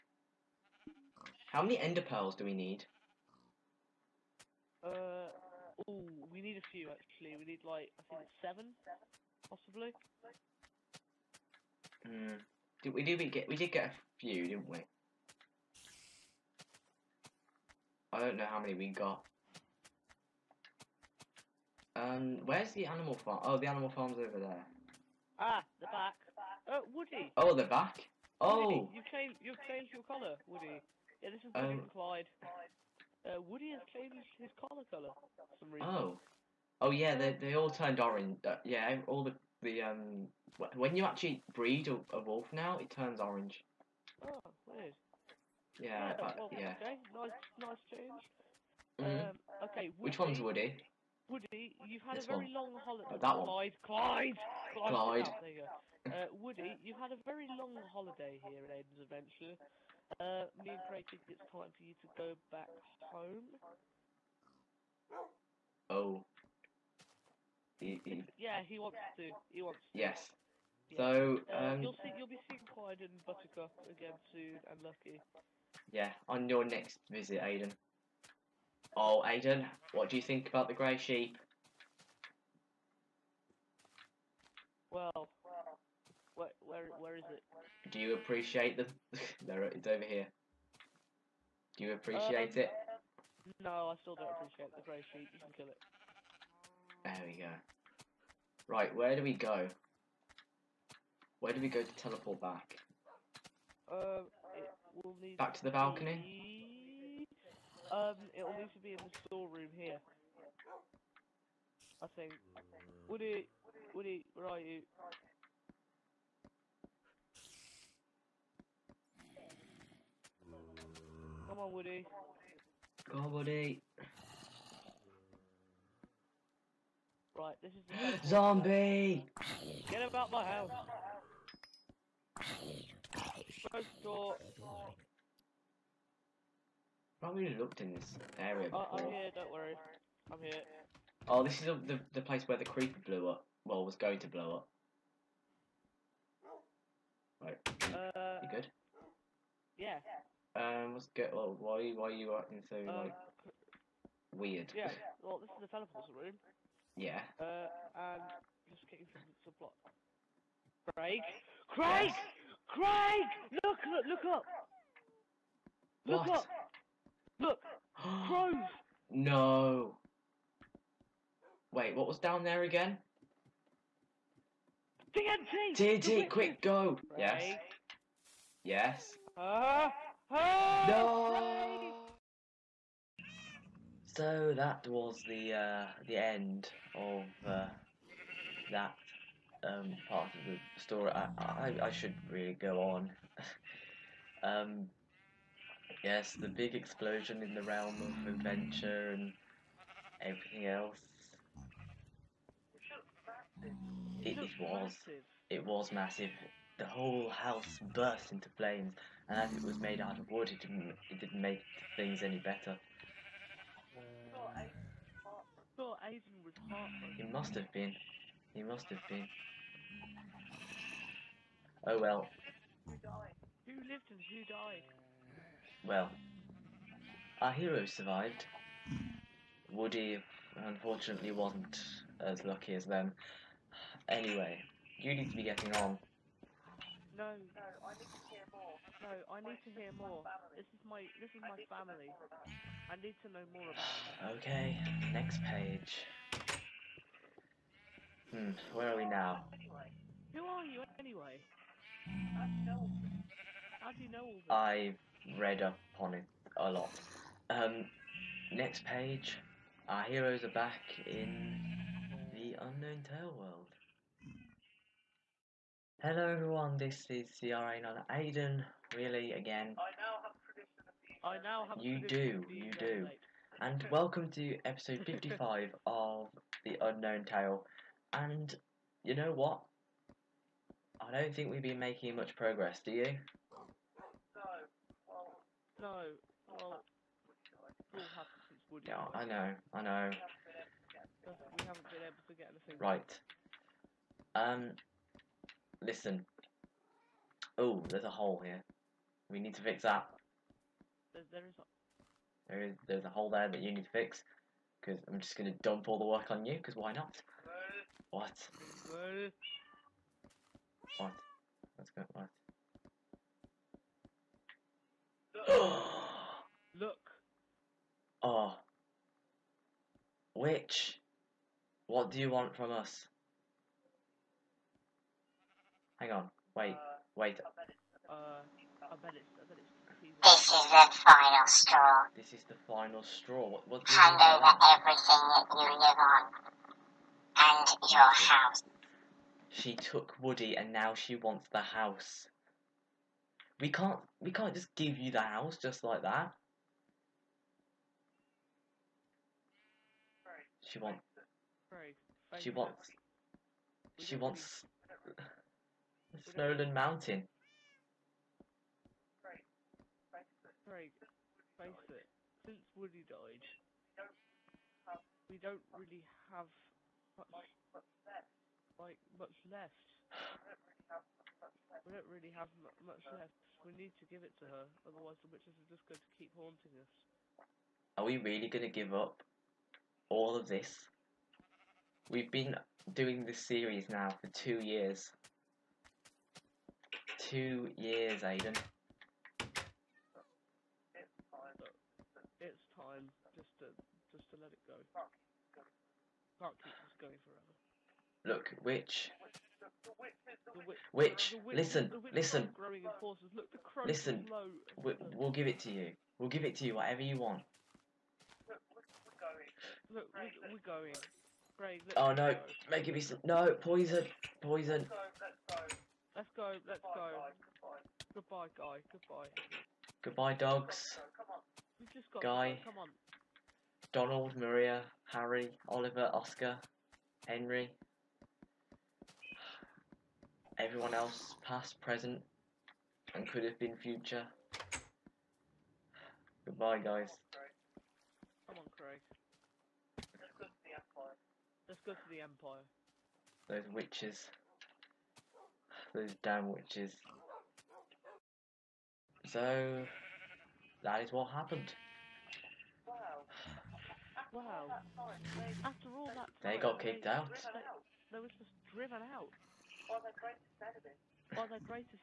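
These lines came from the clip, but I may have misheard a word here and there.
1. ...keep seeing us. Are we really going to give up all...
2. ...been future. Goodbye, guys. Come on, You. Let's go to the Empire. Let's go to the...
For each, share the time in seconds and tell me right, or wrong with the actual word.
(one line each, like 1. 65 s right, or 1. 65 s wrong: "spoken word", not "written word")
1. 376 s wrong: "haunting", not "seeing"
2. 433 s wrong: "Craig", not "You".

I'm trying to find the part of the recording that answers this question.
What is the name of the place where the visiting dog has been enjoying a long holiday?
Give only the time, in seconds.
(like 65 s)
58 s.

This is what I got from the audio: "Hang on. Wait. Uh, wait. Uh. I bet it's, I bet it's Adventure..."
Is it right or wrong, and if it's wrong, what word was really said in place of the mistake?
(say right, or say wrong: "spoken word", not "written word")
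wrong: "This", not "Adventure".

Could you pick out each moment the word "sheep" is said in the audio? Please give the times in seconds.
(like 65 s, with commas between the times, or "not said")
80 s, 95 s.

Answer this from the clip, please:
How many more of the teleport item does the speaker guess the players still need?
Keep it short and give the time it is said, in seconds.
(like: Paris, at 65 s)
7, at 8 s.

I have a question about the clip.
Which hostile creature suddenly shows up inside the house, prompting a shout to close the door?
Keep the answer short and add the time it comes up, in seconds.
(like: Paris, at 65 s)
Zombie, at 128 s.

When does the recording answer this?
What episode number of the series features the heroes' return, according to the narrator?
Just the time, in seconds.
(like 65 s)
275 s.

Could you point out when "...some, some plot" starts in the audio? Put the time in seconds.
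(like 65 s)
159 s.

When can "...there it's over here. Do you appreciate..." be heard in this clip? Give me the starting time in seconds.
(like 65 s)
89 s.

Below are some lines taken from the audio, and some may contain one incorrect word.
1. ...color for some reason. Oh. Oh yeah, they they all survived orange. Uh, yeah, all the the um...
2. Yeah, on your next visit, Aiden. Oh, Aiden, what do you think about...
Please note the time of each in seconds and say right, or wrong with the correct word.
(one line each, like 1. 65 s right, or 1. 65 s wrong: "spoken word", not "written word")
1. 34 s wrong: "turned", not "survived"
2. 75 s right.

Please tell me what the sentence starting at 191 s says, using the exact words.
I, I, I should really go on.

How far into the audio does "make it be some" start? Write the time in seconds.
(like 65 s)
412 s.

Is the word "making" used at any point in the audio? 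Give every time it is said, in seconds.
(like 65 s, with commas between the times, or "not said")
281 s.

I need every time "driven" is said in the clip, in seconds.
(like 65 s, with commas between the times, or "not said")
458 s.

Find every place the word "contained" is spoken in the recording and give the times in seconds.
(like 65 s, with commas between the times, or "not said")
not said.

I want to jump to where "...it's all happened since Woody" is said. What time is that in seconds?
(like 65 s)
287 s.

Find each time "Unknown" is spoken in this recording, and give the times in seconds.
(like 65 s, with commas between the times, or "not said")
262 s, 276 s.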